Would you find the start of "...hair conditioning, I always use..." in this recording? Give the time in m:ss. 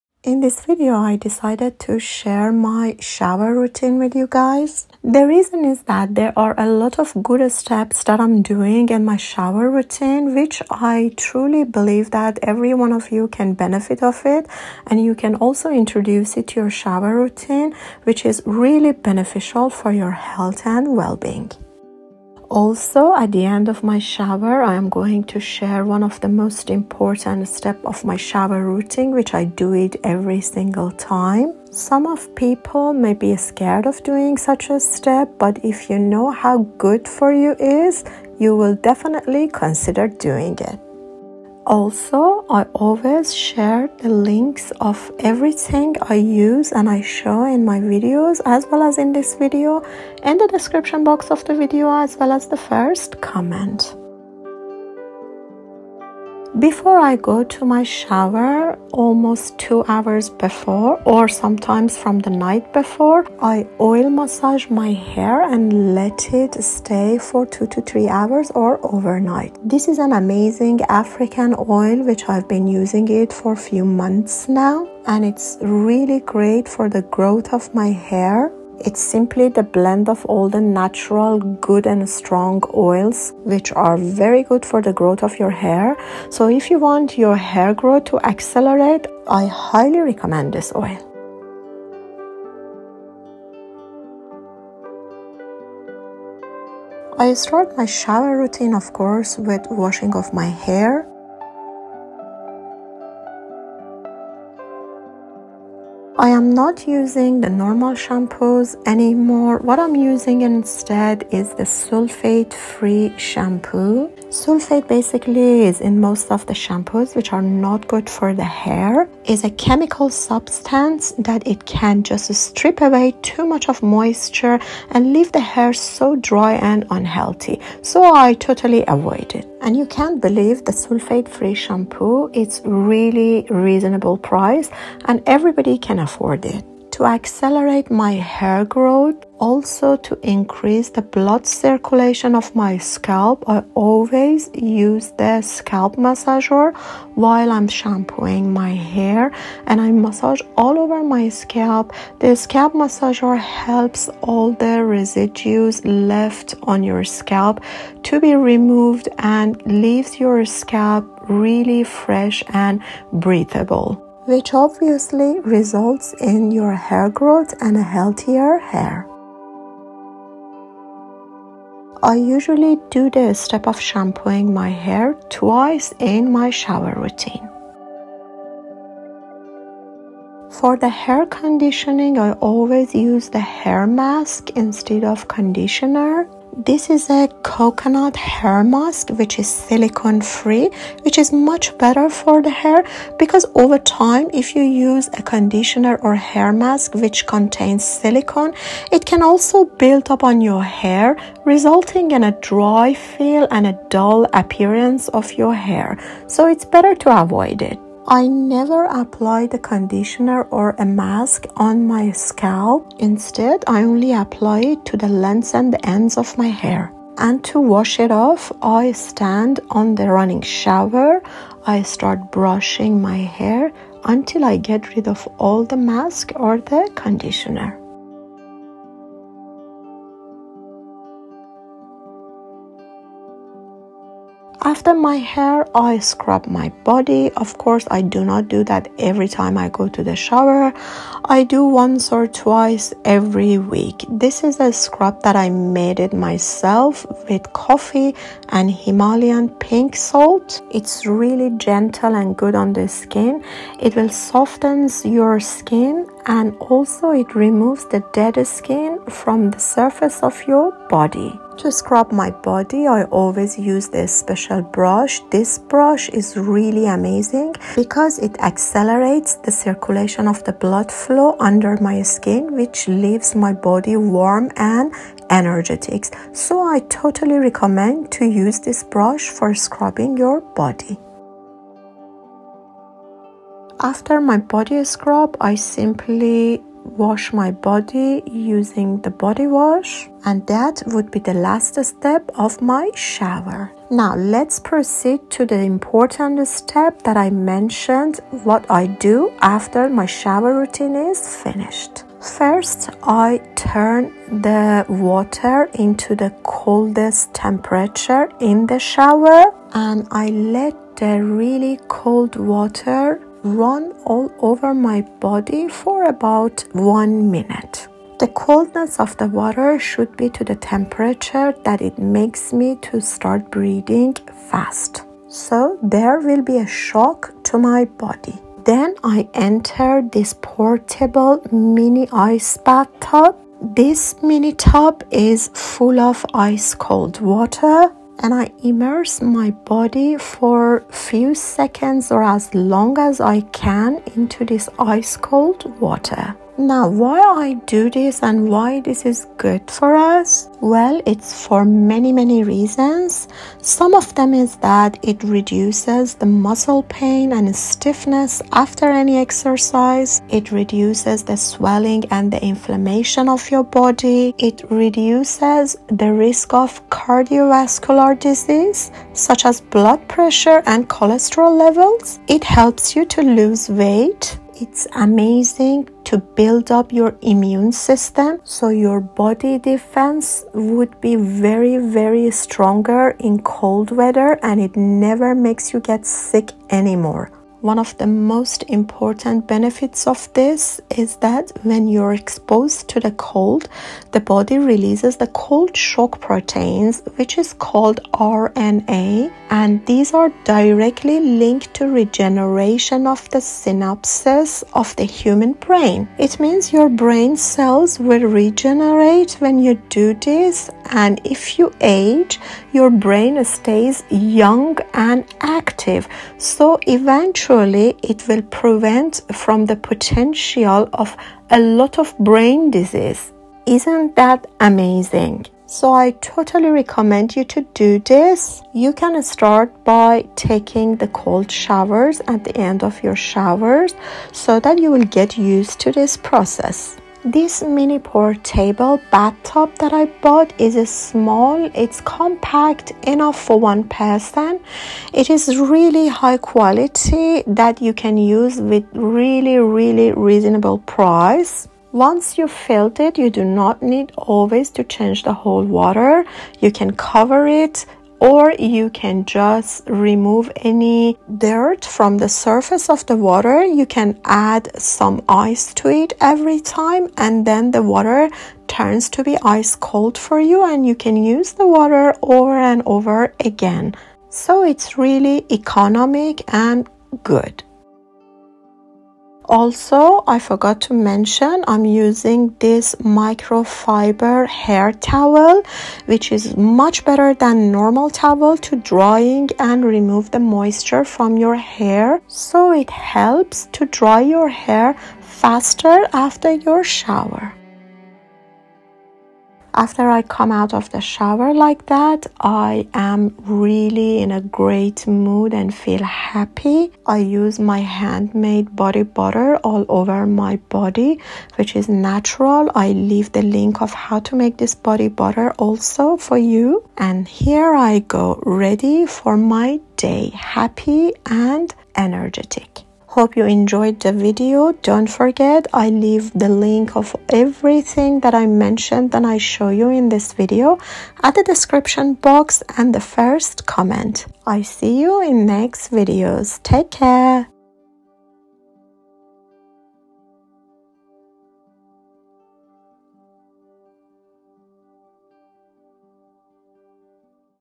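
3:01.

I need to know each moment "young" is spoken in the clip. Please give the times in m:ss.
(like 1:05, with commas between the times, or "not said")
6:54.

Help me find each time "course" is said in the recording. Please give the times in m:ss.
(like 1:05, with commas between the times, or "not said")
1:38, 3:57.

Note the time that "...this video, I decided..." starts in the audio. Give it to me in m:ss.
0:00.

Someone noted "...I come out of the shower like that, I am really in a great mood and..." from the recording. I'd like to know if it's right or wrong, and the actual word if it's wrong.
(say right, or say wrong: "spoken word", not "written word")
right.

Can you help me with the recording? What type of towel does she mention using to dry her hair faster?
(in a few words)
Microfiber hair towel.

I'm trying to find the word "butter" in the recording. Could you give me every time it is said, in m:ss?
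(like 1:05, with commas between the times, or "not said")
8:29, 8:35.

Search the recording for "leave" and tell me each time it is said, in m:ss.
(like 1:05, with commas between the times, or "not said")
2:05, 2:39, 4:32, 8:32, 8:45.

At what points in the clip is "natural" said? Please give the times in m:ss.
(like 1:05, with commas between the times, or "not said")
1:20, 8:31.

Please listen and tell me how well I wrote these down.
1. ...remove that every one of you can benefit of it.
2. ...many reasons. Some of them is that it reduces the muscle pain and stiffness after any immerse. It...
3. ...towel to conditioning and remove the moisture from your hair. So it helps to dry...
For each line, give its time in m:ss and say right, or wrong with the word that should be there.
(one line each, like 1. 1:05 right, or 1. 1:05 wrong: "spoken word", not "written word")
1. 0:11 wrong: "believe", not "remove"
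2. 5:52 wrong: "exercise", not "immerse"
3. 8:08 wrong: "drying", not "conditioning".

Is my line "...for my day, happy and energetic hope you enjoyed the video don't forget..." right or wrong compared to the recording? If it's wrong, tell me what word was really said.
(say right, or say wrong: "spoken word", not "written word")
right.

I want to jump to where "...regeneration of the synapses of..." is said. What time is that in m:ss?
6:41.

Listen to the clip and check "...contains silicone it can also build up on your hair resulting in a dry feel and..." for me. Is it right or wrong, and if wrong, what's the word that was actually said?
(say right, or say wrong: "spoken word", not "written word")
right.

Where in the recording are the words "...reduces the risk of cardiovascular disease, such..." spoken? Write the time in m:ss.
6:04.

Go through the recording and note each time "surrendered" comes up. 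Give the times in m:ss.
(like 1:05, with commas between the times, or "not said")
not said.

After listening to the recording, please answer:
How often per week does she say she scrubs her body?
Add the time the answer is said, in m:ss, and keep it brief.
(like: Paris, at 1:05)
Once or twice, at 4:01.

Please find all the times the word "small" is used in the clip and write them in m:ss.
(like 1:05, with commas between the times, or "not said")
7:20.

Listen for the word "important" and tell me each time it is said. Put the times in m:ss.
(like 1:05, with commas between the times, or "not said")
0:26, 4:55, 6:28.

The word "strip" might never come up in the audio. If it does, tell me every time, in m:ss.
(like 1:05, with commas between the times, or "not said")
2:02.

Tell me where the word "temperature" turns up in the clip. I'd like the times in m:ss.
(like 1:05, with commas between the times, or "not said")
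5:07, 5:20.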